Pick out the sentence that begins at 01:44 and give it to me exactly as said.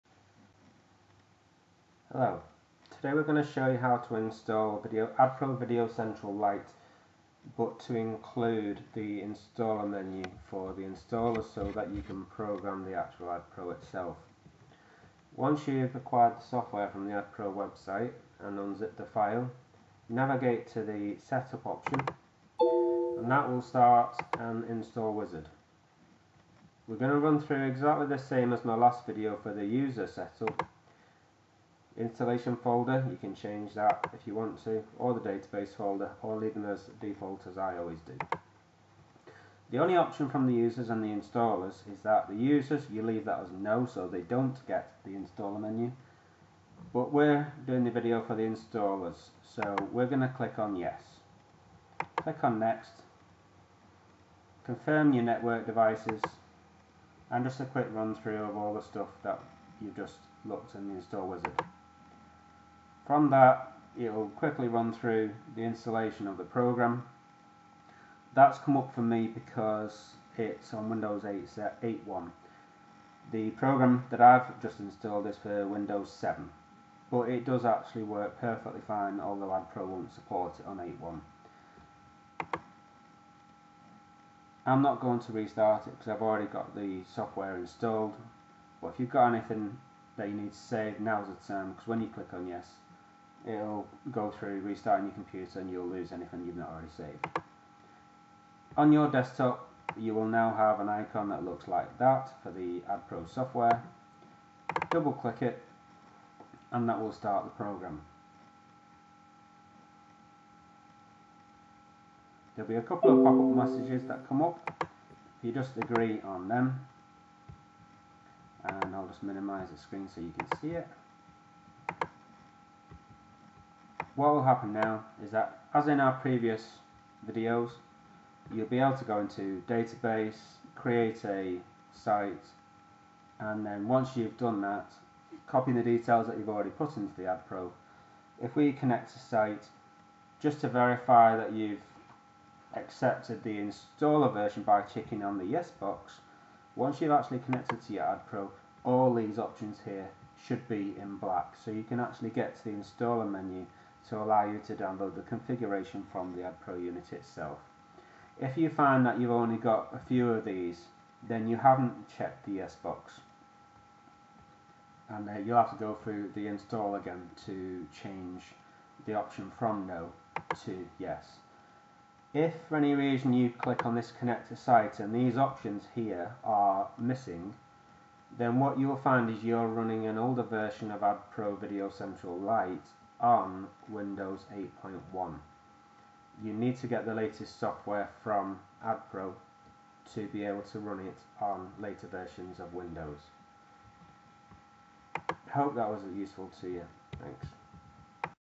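Double click it, and that will start the program.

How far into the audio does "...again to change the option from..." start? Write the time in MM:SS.
02:46.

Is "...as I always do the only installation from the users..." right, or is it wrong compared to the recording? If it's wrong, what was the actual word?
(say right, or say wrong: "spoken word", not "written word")
wrong: "option", not "installation".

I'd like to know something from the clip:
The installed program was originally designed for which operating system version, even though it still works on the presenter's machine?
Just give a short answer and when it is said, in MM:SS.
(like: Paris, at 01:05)
Windows 7, at 01:15.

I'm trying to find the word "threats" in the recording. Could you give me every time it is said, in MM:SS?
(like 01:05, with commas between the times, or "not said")
not said.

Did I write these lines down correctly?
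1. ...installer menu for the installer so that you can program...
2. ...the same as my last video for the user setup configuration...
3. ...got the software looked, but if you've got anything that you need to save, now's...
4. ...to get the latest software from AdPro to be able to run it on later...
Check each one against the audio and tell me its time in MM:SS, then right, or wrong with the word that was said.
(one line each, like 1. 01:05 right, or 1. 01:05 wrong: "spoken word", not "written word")
1. 00:09 right
2. 00:28 wrong: "installation", not "configuration"
3. 01:26 wrong: "installed", not "looked"
4. 03:06 right.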